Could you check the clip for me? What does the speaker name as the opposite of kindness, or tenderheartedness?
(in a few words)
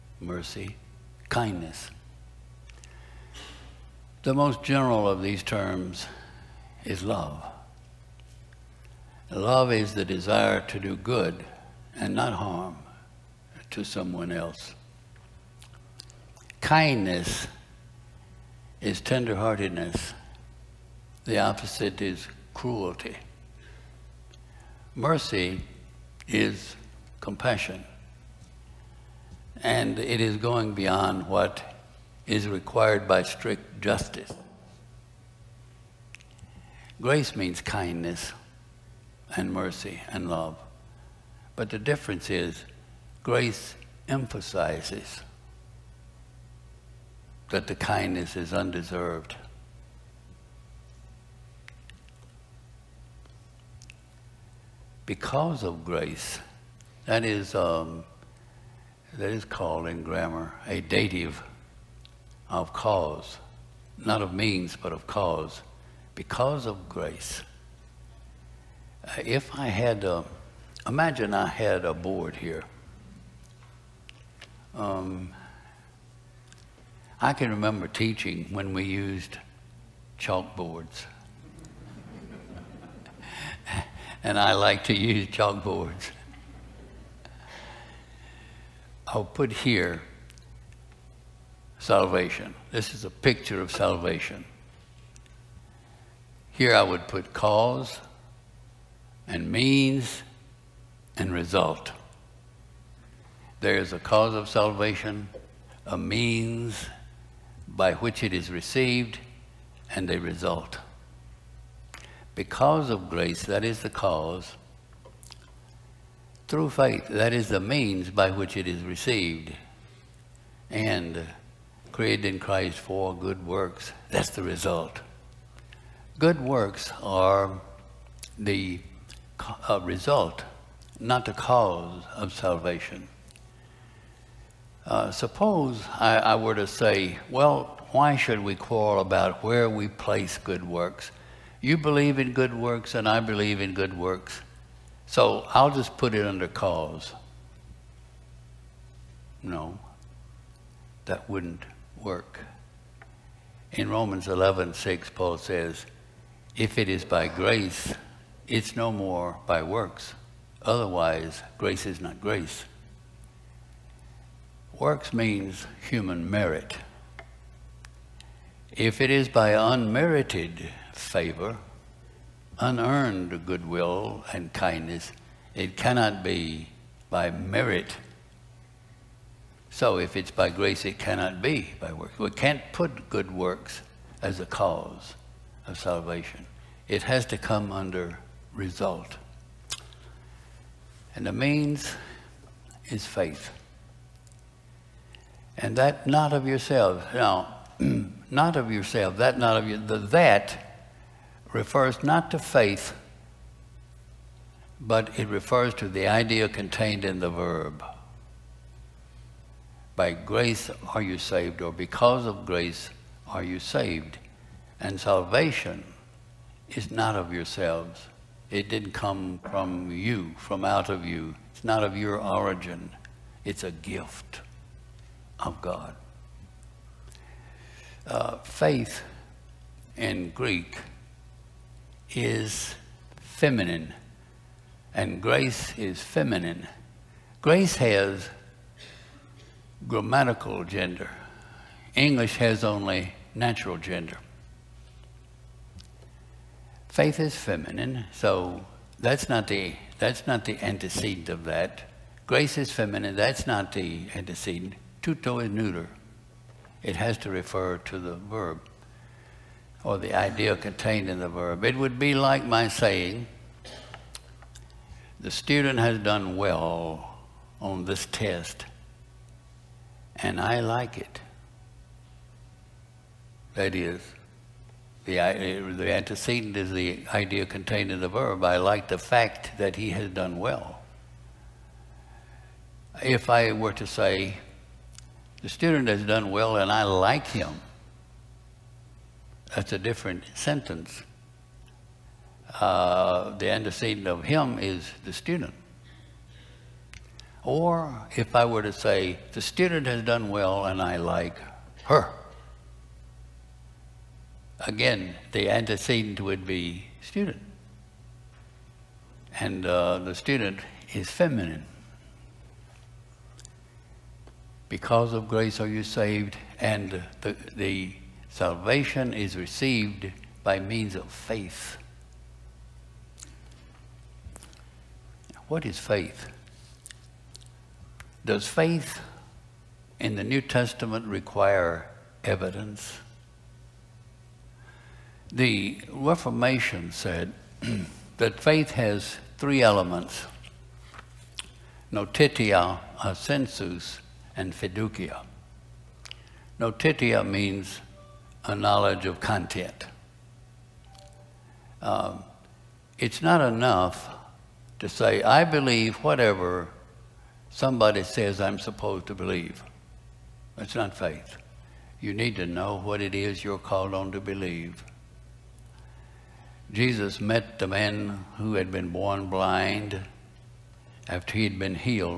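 Cruelty.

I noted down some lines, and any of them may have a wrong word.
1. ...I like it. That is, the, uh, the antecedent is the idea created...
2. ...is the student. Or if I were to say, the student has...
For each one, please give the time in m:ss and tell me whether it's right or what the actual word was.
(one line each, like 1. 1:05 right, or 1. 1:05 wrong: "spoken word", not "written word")
1. 4:30 wrong: "contained", not "created"
2. 4:54 right.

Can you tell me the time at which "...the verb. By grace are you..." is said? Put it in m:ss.
3:27.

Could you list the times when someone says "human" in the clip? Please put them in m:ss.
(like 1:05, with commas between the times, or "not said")
2:45.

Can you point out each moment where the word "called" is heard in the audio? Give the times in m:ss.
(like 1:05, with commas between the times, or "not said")
0:59, 6:03.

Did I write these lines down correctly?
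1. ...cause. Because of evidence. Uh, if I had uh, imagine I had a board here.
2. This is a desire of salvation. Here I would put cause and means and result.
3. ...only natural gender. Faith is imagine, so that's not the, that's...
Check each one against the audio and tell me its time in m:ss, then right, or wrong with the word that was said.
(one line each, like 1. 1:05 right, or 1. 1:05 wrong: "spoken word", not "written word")
1. 1:05 wrong: "grace", not "evidence"
2. 1:32 wrong: "picture", not "desire"
3. 4:02 wrong: "feminine", not "imagine".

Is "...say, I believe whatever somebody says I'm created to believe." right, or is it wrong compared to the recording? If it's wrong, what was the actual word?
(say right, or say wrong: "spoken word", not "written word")
wrong: "supposed", not "created".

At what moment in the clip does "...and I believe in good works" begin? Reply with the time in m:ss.
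2:22.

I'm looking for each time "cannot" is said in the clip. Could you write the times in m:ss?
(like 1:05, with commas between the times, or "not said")
2:55, 3:00.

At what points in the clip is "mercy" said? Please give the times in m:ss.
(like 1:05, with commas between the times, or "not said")
0:00, 0:24, 0:39.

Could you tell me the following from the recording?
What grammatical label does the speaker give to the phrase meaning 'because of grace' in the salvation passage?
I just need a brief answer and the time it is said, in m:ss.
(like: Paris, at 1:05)
Dative of cause, at 1:00.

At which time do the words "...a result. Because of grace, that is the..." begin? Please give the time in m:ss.
1:50.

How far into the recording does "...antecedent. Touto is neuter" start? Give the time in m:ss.
4:14.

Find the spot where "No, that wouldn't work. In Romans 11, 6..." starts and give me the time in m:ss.
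2:29.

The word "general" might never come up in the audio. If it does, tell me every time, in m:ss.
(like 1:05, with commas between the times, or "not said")
0:04.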